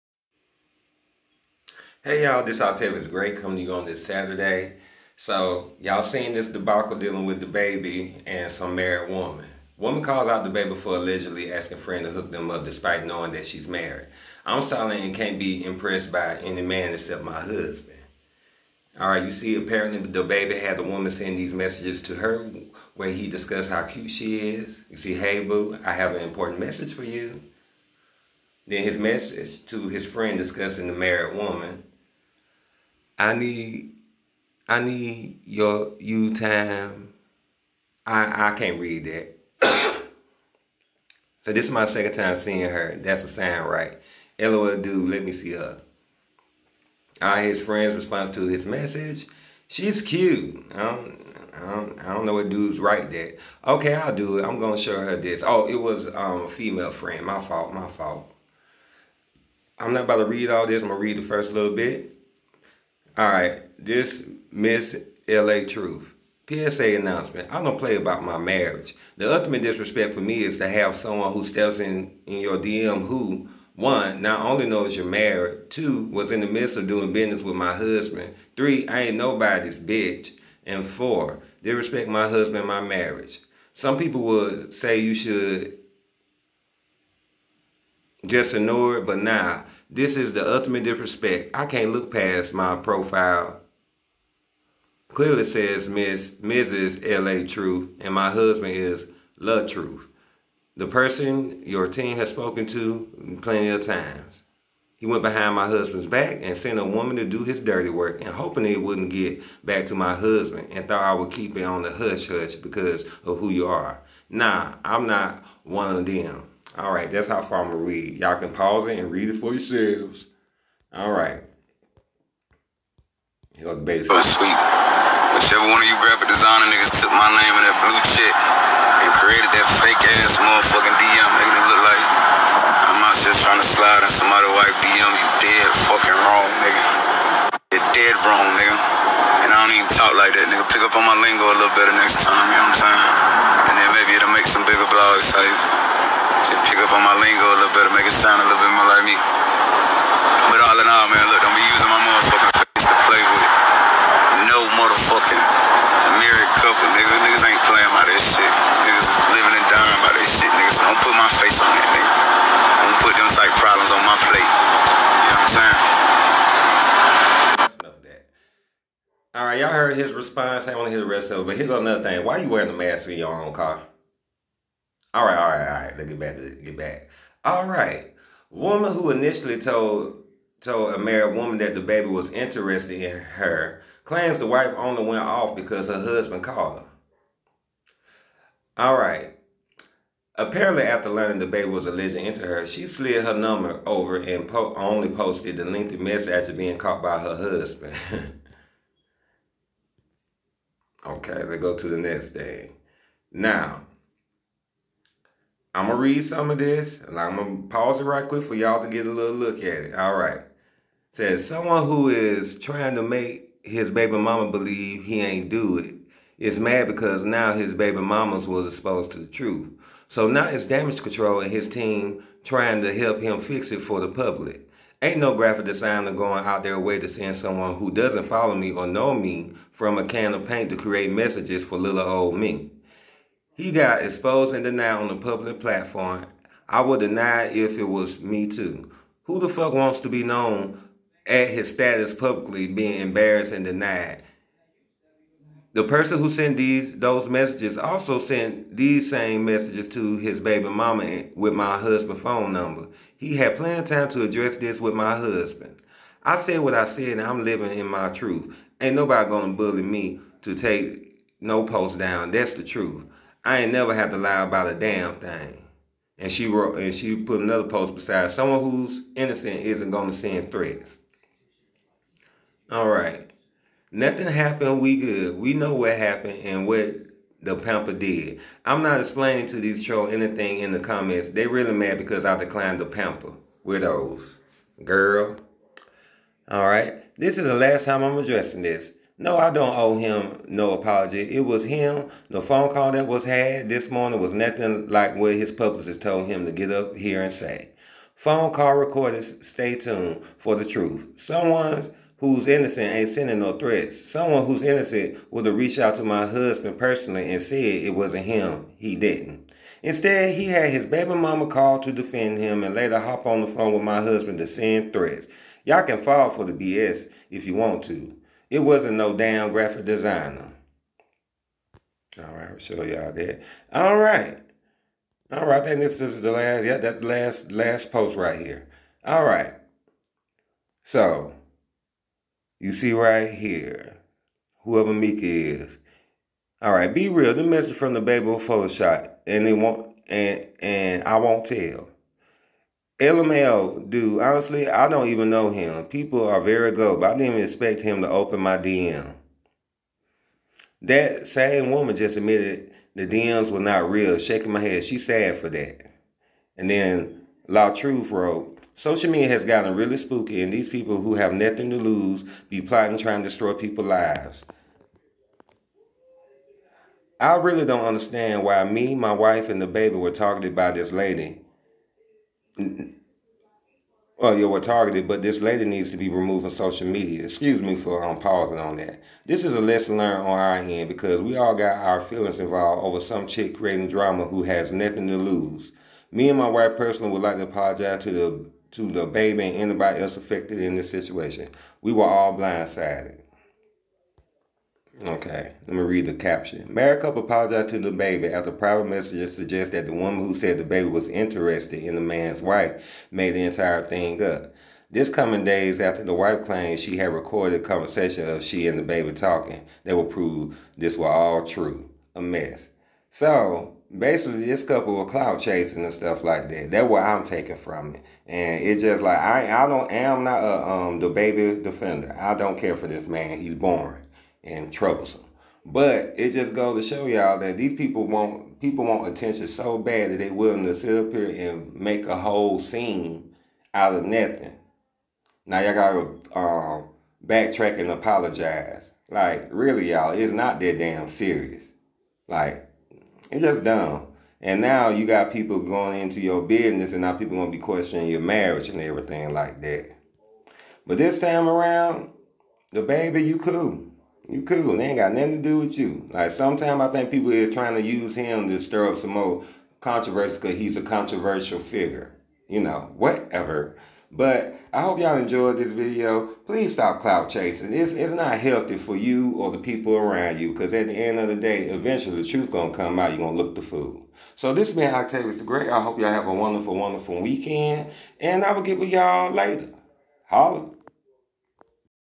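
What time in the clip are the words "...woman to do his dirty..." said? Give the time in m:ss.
1:46.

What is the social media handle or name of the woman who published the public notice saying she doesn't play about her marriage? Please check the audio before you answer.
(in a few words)
Miss LA Truth.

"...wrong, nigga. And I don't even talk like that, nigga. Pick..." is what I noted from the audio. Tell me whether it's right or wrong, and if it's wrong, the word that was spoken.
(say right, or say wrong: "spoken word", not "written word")
right.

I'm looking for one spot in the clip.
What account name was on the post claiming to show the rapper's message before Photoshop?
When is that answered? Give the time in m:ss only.
5:34.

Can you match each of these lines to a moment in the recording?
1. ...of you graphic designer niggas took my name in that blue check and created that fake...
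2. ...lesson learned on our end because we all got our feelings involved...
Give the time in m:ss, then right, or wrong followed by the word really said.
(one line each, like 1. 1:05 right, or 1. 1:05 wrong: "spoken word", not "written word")
1. 2:05 right
2. 6:19 right.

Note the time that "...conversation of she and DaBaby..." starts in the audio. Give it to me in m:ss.
6:47.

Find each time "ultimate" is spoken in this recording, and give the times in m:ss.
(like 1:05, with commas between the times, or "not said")
1:09, 1:30.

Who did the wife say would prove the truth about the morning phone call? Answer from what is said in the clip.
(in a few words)
Phone call recorders.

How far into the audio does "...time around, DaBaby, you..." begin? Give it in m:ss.
7:31.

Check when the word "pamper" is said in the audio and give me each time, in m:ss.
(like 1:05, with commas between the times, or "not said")
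4:37, 4:42.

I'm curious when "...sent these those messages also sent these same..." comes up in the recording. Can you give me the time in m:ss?
4:06.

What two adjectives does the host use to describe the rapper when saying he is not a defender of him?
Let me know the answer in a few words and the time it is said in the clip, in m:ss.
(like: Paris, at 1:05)
boring and troublesome, at 7:03.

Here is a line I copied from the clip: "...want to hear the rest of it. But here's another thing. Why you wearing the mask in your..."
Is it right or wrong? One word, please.
right.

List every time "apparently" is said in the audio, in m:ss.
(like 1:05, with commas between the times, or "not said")
0:19, 3:10.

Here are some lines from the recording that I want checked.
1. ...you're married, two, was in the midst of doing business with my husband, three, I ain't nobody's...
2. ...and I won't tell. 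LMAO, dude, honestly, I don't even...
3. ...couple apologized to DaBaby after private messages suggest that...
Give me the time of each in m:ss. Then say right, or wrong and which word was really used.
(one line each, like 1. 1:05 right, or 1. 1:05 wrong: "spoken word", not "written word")
1. 1:14 right
2. 5:40 right
3. 6:37 right.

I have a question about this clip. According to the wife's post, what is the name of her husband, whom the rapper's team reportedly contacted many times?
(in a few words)
Love Truth.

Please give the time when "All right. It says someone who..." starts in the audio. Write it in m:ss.
3:29.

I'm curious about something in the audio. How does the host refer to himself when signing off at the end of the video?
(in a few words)
Octavious the Great.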